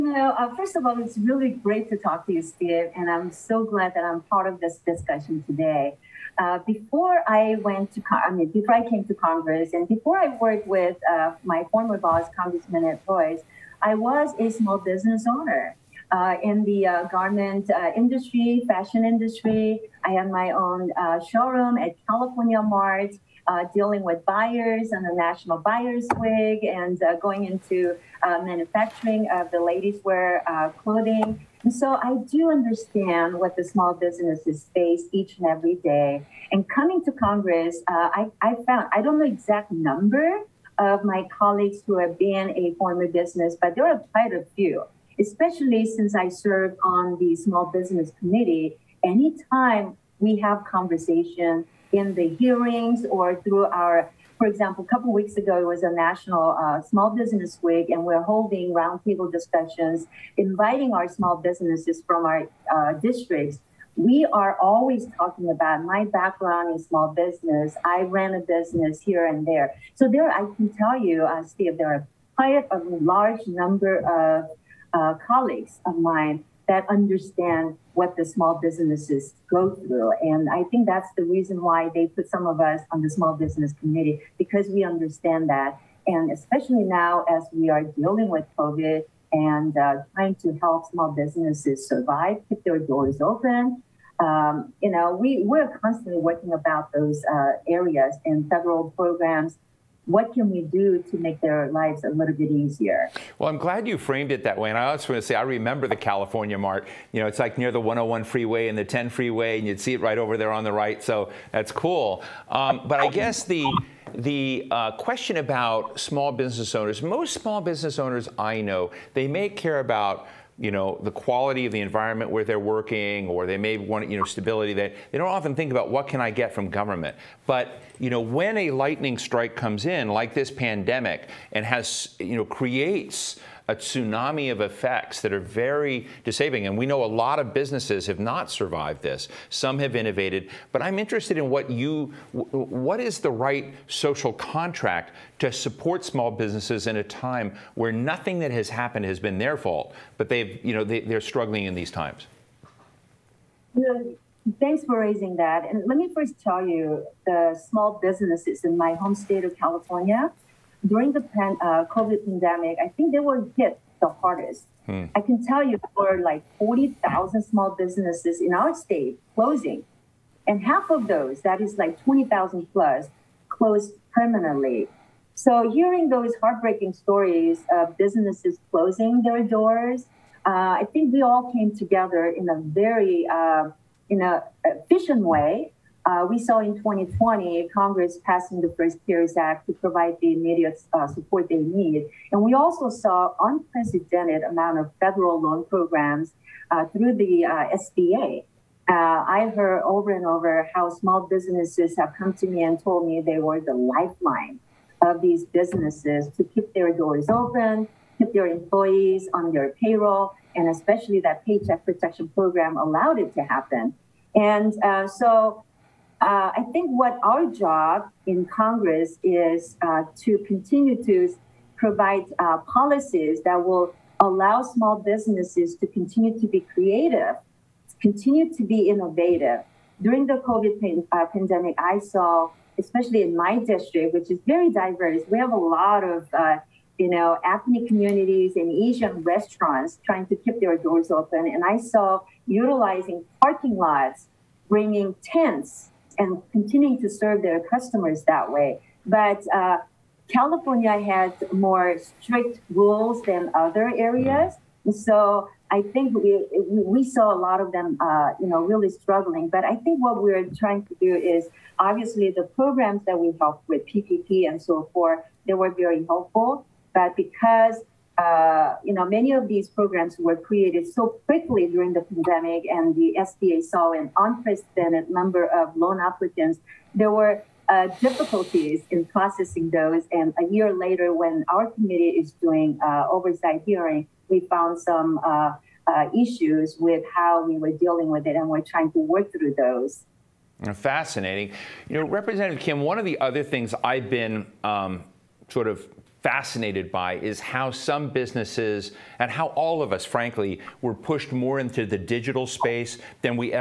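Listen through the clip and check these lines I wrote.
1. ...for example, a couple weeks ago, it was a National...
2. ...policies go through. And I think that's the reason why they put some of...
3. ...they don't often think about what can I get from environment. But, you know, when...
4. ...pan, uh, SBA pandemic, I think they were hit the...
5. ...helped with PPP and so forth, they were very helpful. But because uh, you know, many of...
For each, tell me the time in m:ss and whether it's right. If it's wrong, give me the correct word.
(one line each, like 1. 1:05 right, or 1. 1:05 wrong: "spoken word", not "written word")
1. 0:54 right
2. 1:18 wrong: "businesses", not "policies"
3. 2:05 wrong: "government", not "environment"
4. 2:41 wrong: "COVID", not "SBA"
5. 4:23 right.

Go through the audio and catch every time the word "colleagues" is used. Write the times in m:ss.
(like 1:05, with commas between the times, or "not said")
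0:41, 1:15.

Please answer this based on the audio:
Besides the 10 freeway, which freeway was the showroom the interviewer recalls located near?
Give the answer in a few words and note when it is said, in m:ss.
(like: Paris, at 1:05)
101, at 1:47.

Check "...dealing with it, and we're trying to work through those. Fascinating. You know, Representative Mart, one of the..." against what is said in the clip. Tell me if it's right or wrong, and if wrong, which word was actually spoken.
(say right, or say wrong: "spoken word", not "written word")
wrong: "Kim", not "Mart".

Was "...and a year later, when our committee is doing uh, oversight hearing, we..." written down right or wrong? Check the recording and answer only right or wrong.
right.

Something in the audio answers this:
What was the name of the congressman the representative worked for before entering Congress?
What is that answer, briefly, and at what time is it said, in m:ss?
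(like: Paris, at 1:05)
Ed Royce, at 0:12.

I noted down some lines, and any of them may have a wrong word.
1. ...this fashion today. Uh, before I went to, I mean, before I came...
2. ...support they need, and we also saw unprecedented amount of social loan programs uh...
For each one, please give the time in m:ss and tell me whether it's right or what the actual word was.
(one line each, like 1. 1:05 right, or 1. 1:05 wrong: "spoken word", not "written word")
1. 0:04 wrong: "discussion", not "fashion"
2. 3:11 wrong: "federal", not "social".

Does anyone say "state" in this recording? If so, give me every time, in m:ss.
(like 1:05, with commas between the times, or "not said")
2:39, 2:48.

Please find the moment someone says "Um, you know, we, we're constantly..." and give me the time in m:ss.
1:34.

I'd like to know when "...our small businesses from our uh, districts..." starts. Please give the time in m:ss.
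1:00.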